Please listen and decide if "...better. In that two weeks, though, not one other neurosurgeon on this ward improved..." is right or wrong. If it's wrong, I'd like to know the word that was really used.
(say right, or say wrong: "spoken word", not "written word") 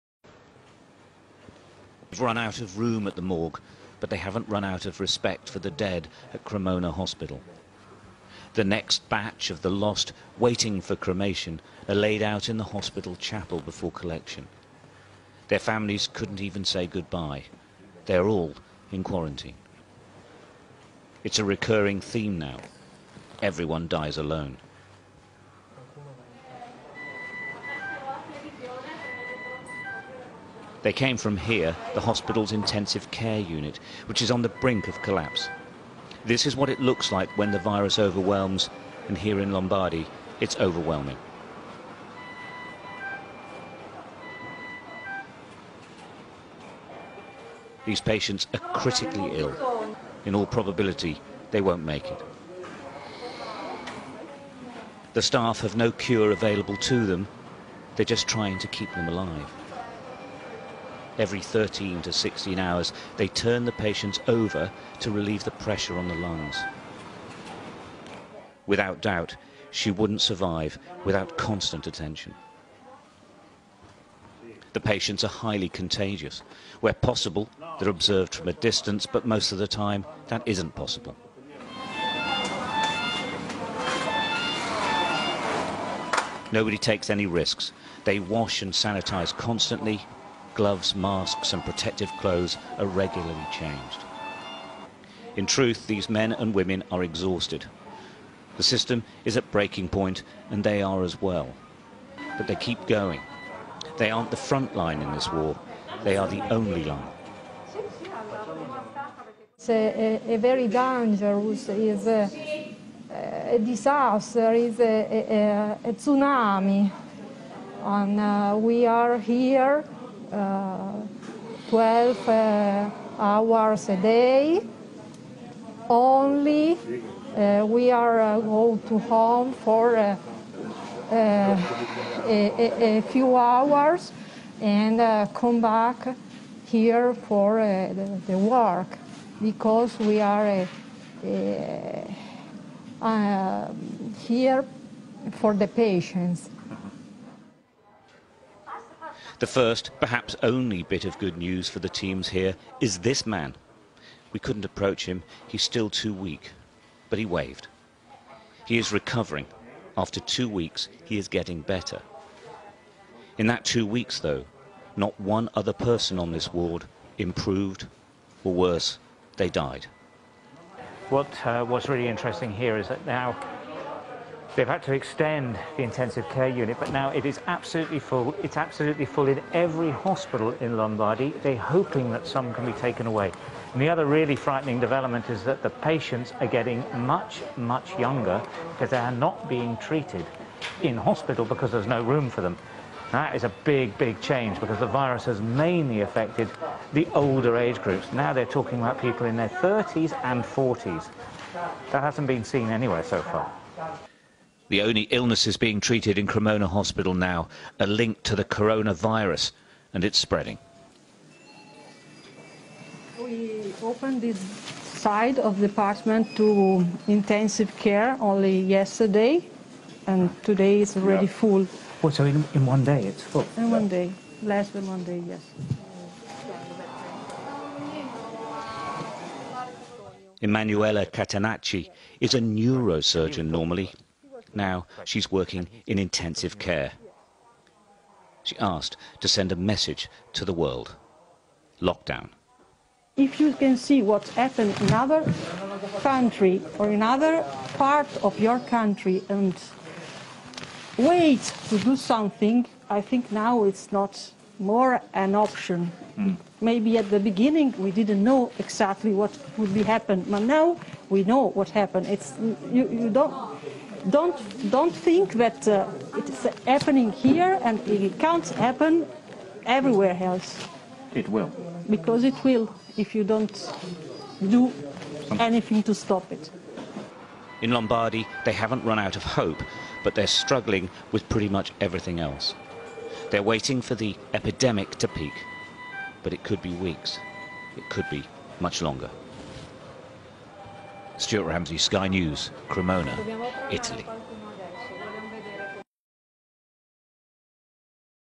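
wrong: "person", not "neurosurgeon".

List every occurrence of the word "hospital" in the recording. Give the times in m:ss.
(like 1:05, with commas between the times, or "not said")
0:06, 0:12, 0:32, 2:59, 3:10, 3:26.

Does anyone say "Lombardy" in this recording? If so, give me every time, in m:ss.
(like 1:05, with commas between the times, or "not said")
0:39, 3:00, 4:37.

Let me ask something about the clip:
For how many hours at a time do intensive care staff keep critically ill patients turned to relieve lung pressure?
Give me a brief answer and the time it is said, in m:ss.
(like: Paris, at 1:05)
13 to 16 hours, at 1:01.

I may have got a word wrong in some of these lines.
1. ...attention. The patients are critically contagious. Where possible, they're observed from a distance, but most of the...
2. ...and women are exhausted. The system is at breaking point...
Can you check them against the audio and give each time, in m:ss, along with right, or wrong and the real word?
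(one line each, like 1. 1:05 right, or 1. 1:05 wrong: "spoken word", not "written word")
1. 1:11 wrong: "highly", not "critically"
2. 1:36 right.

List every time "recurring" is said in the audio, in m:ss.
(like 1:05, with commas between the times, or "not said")
0:21.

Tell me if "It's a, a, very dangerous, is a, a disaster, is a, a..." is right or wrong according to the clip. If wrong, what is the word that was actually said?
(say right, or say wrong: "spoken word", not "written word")
right.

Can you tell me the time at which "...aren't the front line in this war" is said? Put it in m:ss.
1:44.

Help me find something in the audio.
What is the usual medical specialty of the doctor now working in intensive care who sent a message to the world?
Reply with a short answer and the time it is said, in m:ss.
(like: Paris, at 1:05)
neurosurgeon, at 3:52.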